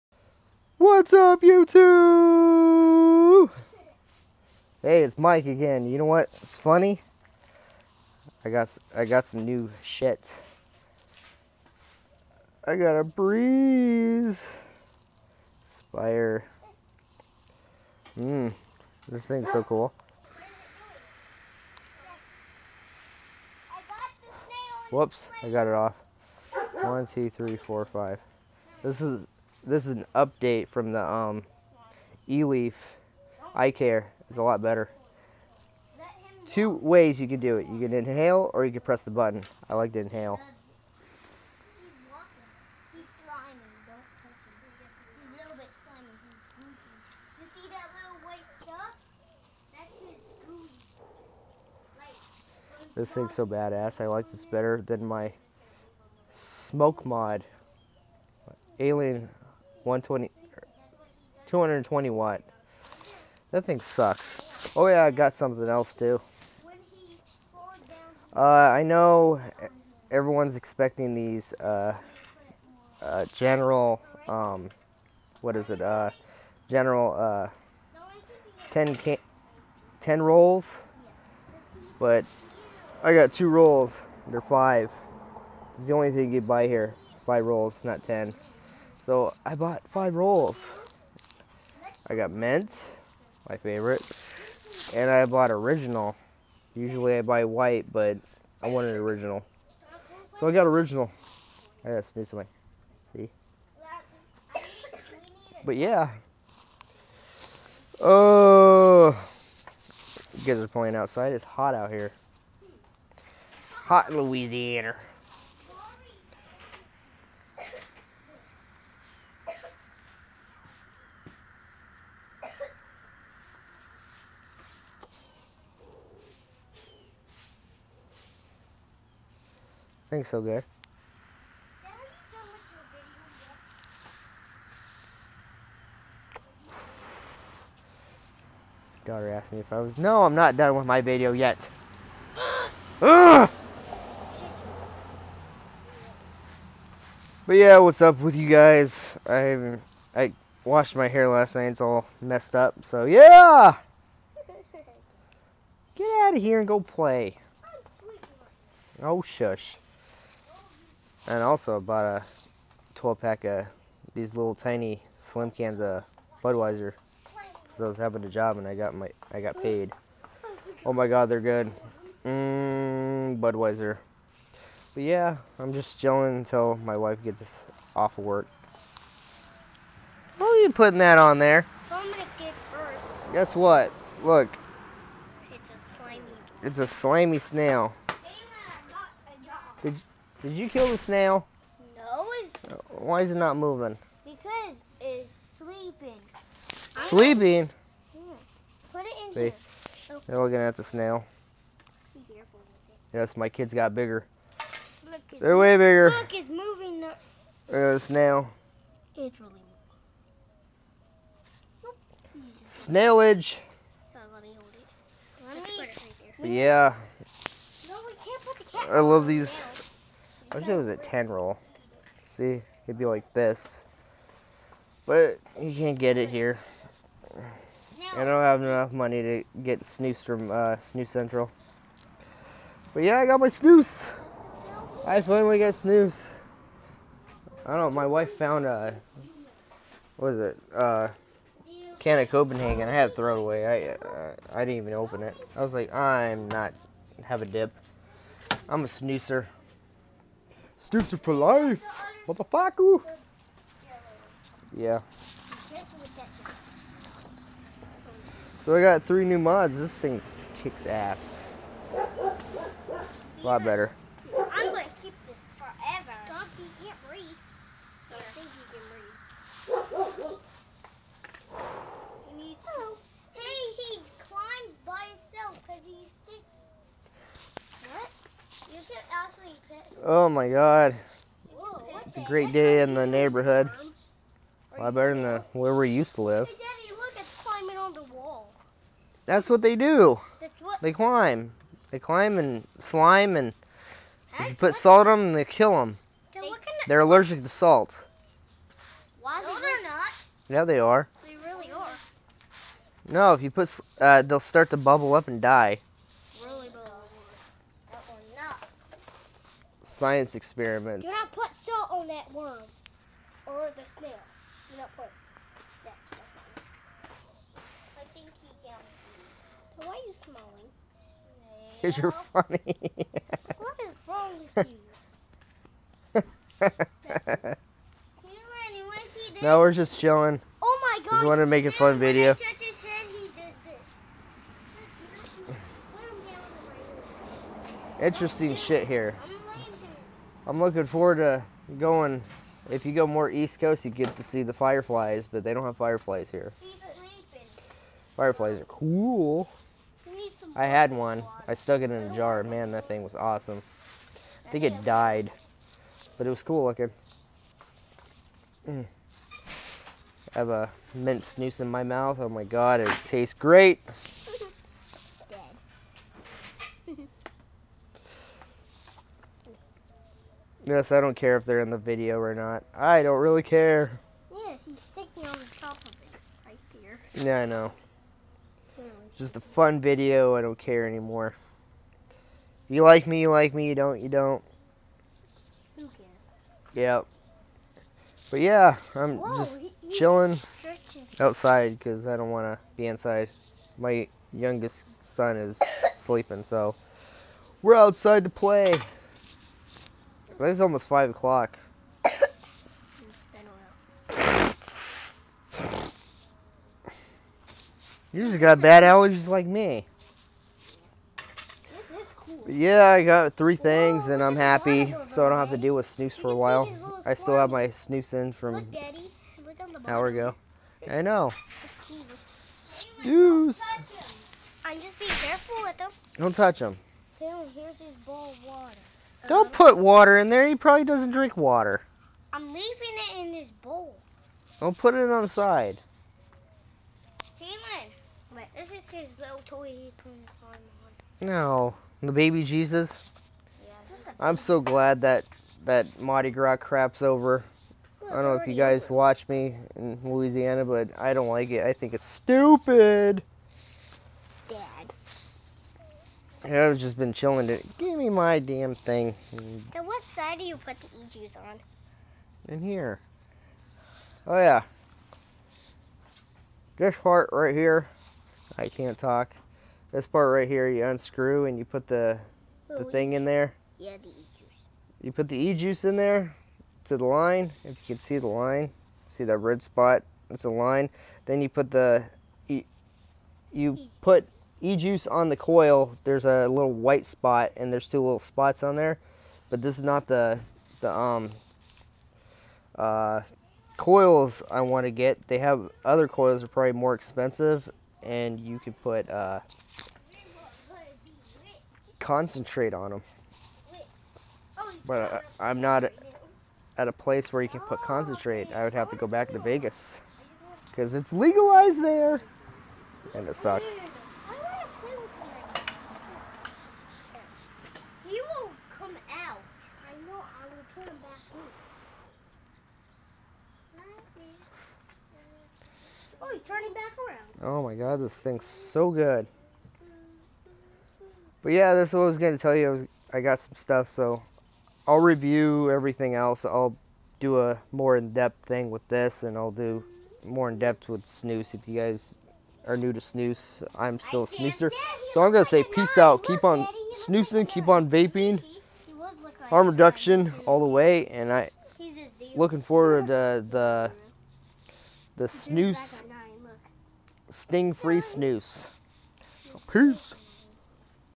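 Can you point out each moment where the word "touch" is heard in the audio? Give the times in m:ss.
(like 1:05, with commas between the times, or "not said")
7:06.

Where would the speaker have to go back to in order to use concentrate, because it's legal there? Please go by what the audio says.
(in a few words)
Vegas.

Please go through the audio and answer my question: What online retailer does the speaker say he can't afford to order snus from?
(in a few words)
Snus Central.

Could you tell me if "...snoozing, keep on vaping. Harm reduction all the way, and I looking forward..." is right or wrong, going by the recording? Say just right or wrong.
right.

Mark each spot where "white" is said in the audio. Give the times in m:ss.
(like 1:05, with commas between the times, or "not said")
1:37, 8:06.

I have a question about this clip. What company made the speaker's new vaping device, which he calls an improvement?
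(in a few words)
e-leaf.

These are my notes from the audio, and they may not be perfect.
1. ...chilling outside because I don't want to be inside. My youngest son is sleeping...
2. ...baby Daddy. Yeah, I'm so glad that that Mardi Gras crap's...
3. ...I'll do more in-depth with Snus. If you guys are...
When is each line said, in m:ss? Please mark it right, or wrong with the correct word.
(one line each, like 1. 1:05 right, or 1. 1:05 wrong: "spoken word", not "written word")
1. 6:29 right
2. 7:22 wrong: "Jesus", not "Daddy"
3. 8:59 right.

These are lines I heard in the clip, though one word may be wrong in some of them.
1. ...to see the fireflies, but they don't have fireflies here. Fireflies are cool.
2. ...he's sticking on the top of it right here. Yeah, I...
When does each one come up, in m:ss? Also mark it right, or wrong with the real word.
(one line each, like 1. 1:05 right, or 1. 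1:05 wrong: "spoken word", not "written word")
1. 5:44 right
2. 6:14 right.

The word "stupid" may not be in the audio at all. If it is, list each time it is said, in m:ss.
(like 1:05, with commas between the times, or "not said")
7:32.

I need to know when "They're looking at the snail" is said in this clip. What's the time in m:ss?
3:20.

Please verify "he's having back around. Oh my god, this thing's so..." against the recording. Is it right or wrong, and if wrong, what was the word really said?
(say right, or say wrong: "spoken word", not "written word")
wrong: "turning", not "having".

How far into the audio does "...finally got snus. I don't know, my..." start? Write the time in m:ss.
3:55.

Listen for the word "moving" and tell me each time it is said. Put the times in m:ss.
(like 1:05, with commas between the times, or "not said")
3:13, 3:26, 3:31.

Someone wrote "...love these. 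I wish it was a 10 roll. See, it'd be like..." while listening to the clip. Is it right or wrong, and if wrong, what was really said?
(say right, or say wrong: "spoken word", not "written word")
right.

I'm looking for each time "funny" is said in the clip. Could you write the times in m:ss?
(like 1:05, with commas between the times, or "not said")
0:06, 5:22.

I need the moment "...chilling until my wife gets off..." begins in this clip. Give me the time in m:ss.
2:55.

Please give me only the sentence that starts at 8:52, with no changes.
I, was, I got some stuff, so I'll review everything else.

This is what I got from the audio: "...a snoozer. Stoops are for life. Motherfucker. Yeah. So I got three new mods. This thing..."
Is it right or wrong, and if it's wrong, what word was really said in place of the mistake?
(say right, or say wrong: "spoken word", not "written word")
right.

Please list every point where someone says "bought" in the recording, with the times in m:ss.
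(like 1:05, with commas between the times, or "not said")
1:29, 1:35, 2:41.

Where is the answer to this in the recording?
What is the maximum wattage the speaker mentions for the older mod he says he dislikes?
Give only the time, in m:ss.
1:01.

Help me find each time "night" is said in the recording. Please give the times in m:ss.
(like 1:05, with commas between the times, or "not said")
2:31.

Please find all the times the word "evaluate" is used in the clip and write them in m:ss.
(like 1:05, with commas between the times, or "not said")
not said.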